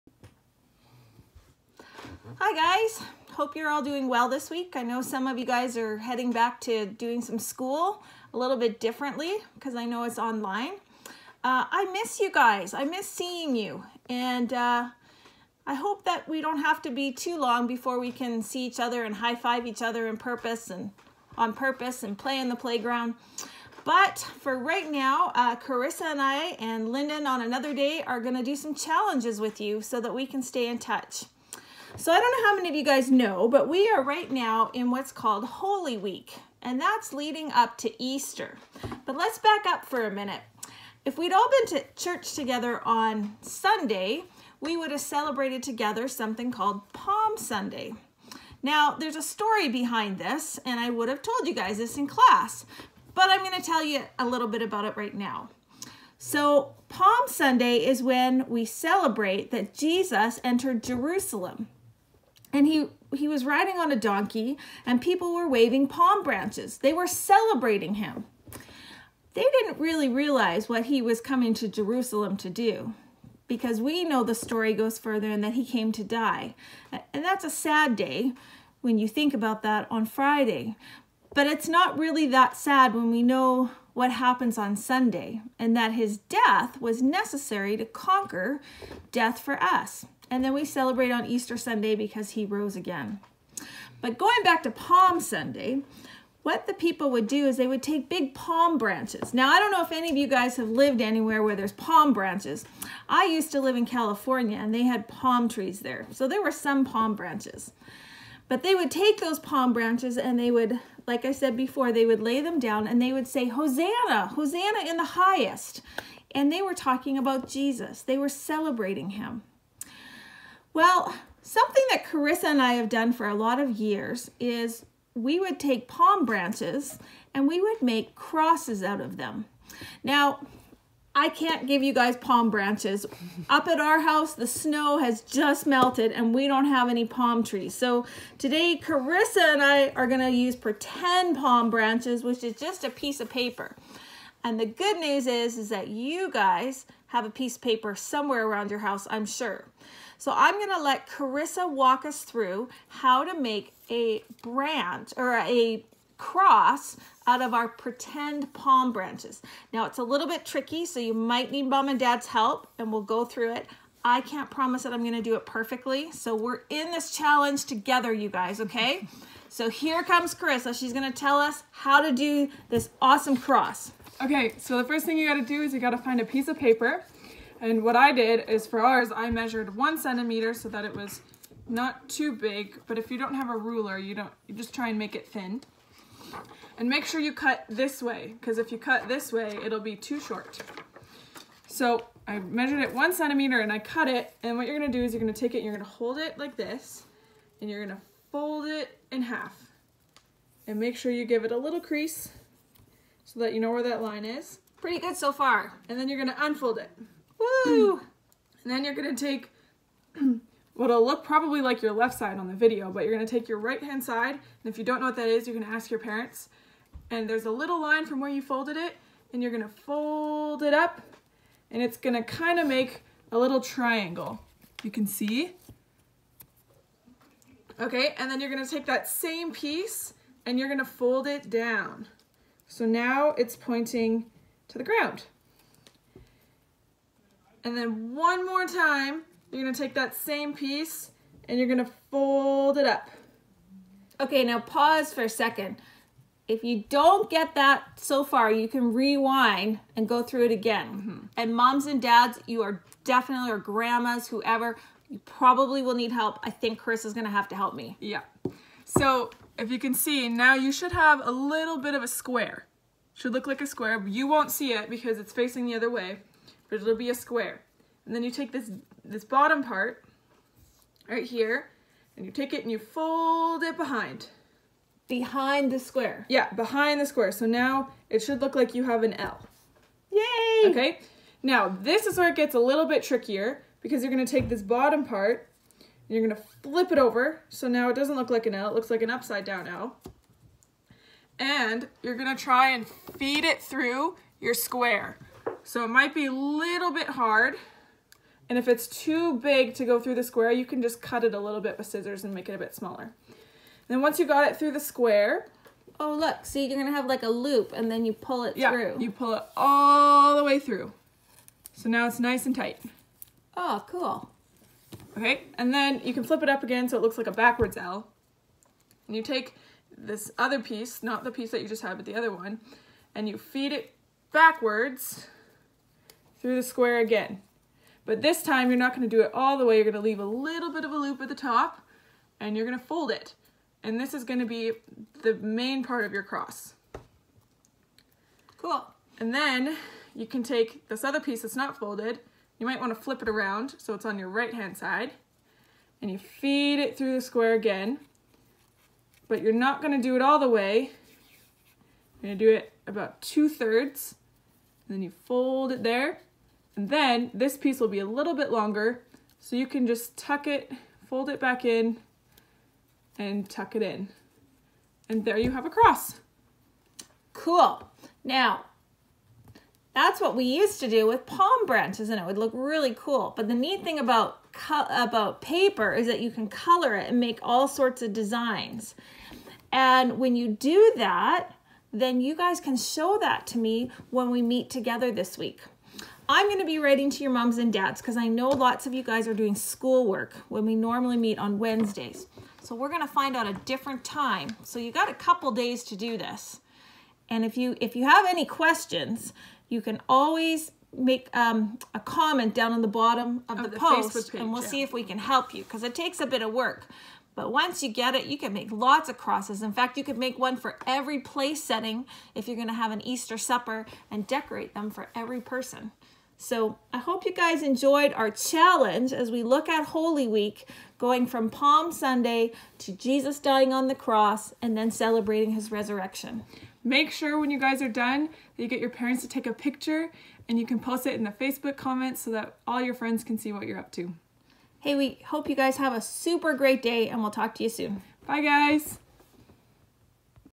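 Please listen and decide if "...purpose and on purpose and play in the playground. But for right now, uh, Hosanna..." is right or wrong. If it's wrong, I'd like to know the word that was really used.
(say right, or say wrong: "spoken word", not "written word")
wrong: "Carissa", not "Hosanna".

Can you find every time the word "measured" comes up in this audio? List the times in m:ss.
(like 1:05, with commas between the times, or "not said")
2:59, 3:12.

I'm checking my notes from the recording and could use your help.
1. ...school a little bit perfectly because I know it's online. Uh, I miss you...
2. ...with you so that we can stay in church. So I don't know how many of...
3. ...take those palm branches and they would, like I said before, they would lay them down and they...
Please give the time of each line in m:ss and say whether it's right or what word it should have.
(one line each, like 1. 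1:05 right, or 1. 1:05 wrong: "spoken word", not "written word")
1. 0:07 wrong: "differently", not "perfectly"
2. 0:29 wrong: "touch", not "church"
3. 1:48 right.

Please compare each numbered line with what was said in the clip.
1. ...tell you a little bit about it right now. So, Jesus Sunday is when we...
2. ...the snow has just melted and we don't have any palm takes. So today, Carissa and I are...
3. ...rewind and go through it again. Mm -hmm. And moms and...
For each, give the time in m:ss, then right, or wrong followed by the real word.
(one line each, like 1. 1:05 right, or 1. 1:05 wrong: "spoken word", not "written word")
1. 0:53 wrong: "Palm", not "Jesus"
2. 2:14 wrong: "trees", not "takes"
3. 4:08 right.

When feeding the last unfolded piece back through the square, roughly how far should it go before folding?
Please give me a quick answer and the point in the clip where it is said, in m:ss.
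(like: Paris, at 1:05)
two thirds, at 5:53.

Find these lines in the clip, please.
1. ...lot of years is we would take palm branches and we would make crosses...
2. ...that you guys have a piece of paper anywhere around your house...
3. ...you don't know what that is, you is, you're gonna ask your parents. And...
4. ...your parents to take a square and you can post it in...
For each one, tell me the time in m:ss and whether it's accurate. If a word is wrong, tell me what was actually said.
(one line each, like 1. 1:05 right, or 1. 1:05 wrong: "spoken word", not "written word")
1. 2:03 right
2. 2:25 wrong: "somewhere", not "anywhere"
3. 3:34 right
4. 7:08 wrong: "picture", not "square".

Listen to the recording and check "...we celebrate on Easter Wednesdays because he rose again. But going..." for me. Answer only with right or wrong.
wrong.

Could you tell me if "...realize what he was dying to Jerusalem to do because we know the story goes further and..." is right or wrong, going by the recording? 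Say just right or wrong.
wrong.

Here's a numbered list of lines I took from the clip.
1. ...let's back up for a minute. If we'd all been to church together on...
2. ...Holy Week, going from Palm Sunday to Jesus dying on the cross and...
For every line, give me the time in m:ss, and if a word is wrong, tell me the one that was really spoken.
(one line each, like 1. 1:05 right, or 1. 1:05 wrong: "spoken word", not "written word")
1. 0:39 right
2. 6:59 right.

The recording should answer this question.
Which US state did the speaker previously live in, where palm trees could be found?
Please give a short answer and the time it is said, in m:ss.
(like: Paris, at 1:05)
California, at 1:43.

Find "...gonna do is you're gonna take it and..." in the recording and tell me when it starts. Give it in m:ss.
3:14.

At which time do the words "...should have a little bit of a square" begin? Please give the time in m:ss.
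4:20.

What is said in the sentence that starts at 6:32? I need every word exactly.
So we're going to find out a different time.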